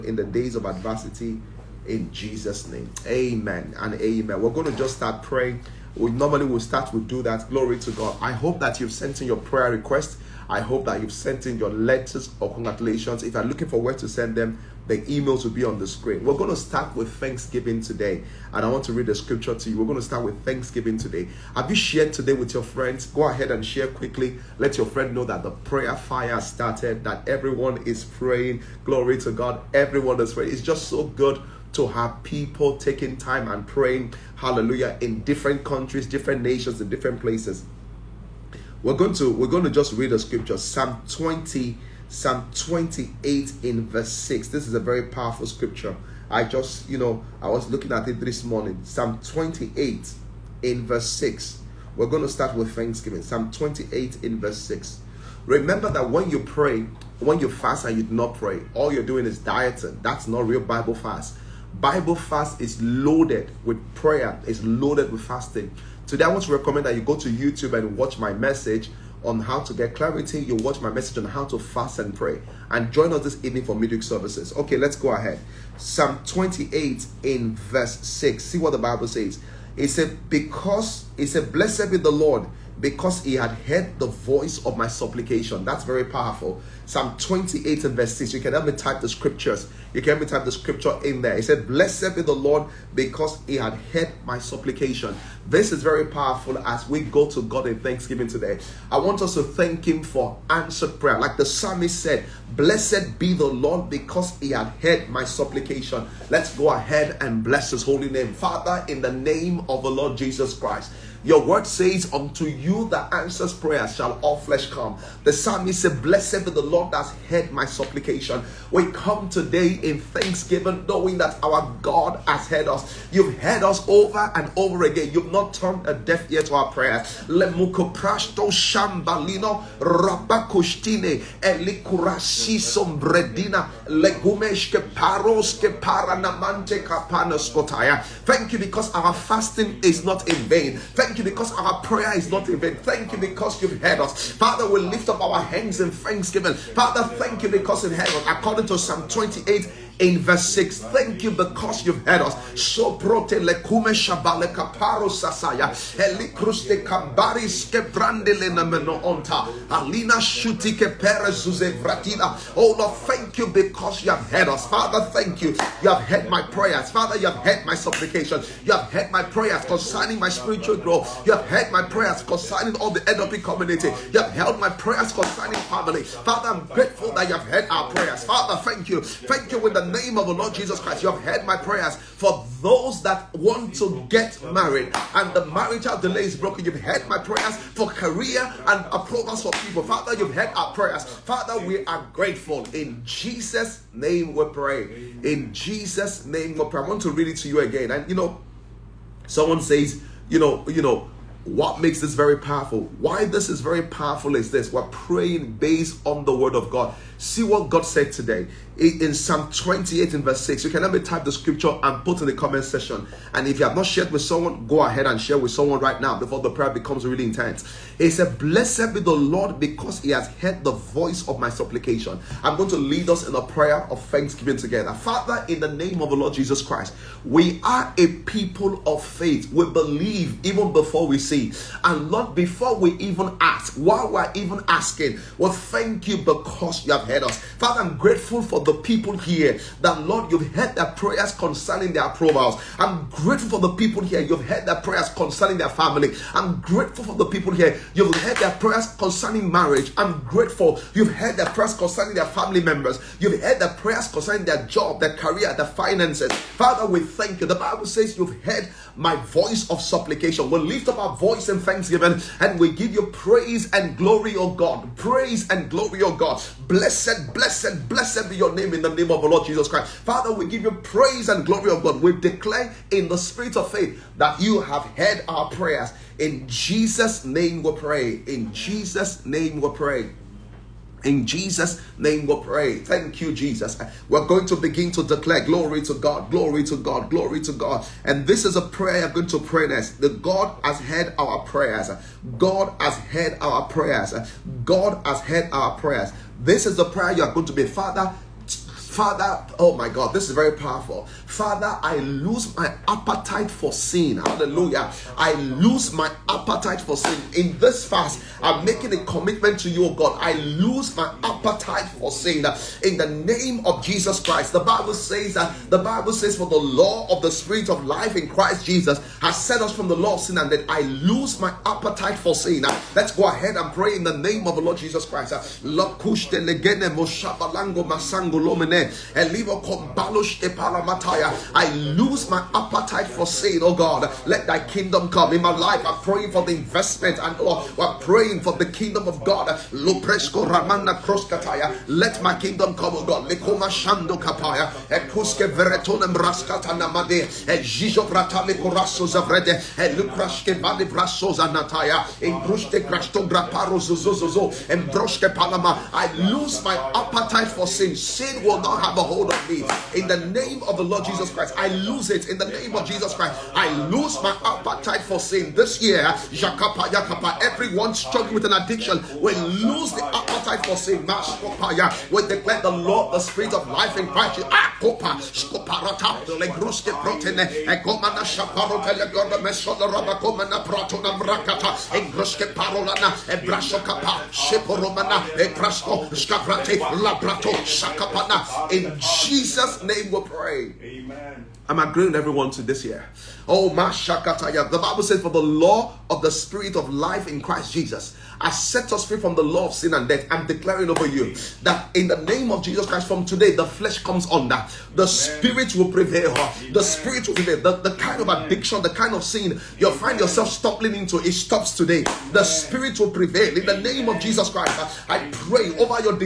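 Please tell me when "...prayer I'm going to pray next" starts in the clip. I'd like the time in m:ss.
4:48.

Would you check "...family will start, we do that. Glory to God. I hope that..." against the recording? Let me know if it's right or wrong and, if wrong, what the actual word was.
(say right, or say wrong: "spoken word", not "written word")
wrong: "normally", not "family".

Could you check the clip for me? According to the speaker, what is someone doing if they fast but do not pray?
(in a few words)
Dieting.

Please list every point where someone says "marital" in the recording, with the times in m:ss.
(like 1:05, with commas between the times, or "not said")
3:05.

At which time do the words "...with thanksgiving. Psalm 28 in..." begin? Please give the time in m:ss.
0:52.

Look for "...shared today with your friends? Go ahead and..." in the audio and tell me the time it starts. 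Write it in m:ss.
0:21.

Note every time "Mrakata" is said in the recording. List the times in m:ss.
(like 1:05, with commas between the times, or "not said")
6:21.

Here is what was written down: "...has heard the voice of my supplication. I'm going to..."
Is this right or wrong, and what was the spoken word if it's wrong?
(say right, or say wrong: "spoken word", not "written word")
right.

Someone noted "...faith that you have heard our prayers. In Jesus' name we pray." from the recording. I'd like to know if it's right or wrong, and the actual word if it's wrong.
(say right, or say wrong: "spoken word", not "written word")
right.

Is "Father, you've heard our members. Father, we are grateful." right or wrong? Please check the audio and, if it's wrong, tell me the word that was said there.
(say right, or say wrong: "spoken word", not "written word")
wrong: "prayers", not "members".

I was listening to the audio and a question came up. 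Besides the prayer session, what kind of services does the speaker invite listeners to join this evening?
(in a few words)
Midweek services.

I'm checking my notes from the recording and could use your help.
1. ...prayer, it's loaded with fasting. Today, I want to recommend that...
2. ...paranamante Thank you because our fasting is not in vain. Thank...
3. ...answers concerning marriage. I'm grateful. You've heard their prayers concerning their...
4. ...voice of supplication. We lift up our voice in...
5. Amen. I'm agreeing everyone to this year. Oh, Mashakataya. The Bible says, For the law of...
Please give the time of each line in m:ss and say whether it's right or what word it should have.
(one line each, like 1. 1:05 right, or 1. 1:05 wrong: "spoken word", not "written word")
1. 1:03 right
2. 2:15 right
3. 4:08 wrong: "prayers", not "answers"
4. 4:19 right
5. 6:31 right.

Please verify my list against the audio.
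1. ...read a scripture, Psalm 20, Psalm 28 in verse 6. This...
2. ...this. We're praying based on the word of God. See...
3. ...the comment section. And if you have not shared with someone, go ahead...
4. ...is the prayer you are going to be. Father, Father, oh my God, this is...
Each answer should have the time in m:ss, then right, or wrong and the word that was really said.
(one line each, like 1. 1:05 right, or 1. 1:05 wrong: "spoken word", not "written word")
1. 0:39 right
2. 3:24 right
3. 3:32 right
4. 4:56 right.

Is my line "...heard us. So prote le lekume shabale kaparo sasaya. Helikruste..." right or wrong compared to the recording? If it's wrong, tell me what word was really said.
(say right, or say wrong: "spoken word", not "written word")
right.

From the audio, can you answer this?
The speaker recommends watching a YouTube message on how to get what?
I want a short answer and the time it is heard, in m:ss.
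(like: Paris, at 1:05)
Clarity, at 1:09.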